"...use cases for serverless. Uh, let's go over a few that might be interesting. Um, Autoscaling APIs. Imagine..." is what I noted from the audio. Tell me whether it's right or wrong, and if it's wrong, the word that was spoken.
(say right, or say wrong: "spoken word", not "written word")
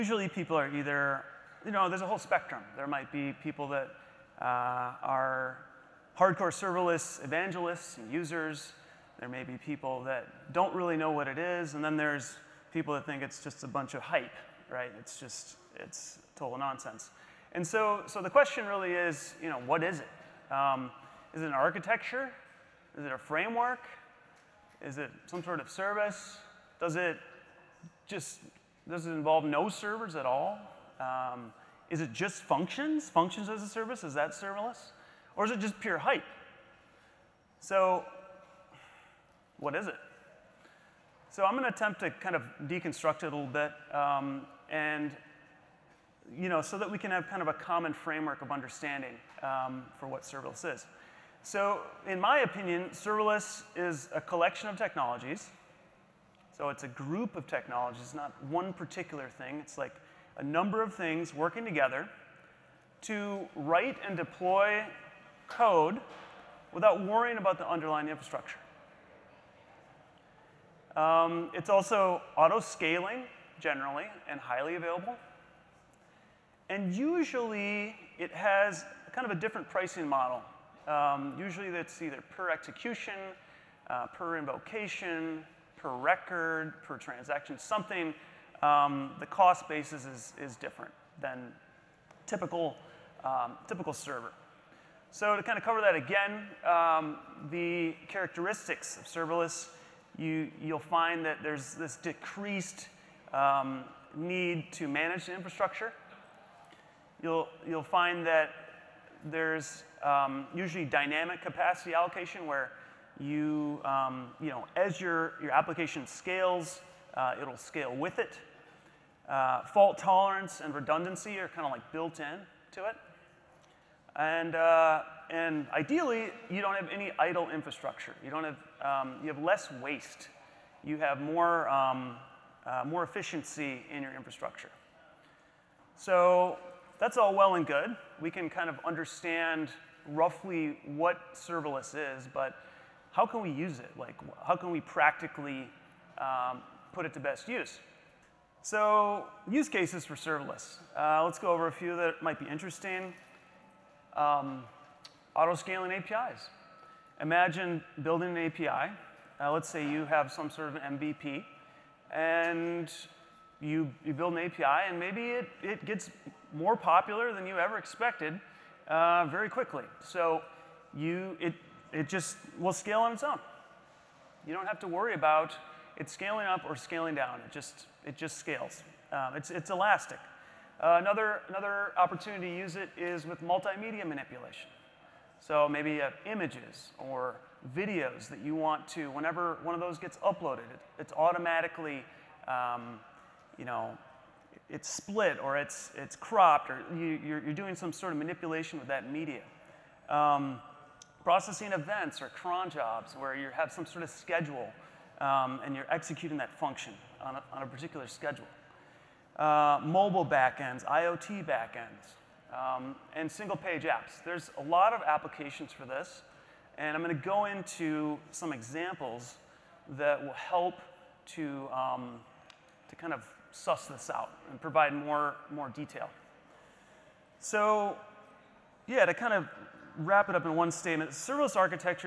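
right.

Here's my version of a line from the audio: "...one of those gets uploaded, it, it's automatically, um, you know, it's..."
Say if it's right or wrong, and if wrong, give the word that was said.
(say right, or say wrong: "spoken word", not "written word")
right.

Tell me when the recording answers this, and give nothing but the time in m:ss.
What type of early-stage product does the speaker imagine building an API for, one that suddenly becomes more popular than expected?
2:40.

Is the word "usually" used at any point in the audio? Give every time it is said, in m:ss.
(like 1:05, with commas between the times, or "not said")
1:16, 1:21, 1:50.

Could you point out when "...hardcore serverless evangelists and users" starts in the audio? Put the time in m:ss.
0:06.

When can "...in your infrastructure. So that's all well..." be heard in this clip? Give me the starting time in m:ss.
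2:13.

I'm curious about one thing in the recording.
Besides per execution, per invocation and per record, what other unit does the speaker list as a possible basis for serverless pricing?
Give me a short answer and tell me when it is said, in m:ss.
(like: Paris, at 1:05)
per transaction, at 1:26.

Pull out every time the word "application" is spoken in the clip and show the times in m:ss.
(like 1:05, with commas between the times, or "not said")
1:55, 3:35.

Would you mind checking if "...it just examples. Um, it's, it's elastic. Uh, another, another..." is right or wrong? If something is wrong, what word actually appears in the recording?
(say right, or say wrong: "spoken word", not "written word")
wrong: "scales", not "examples".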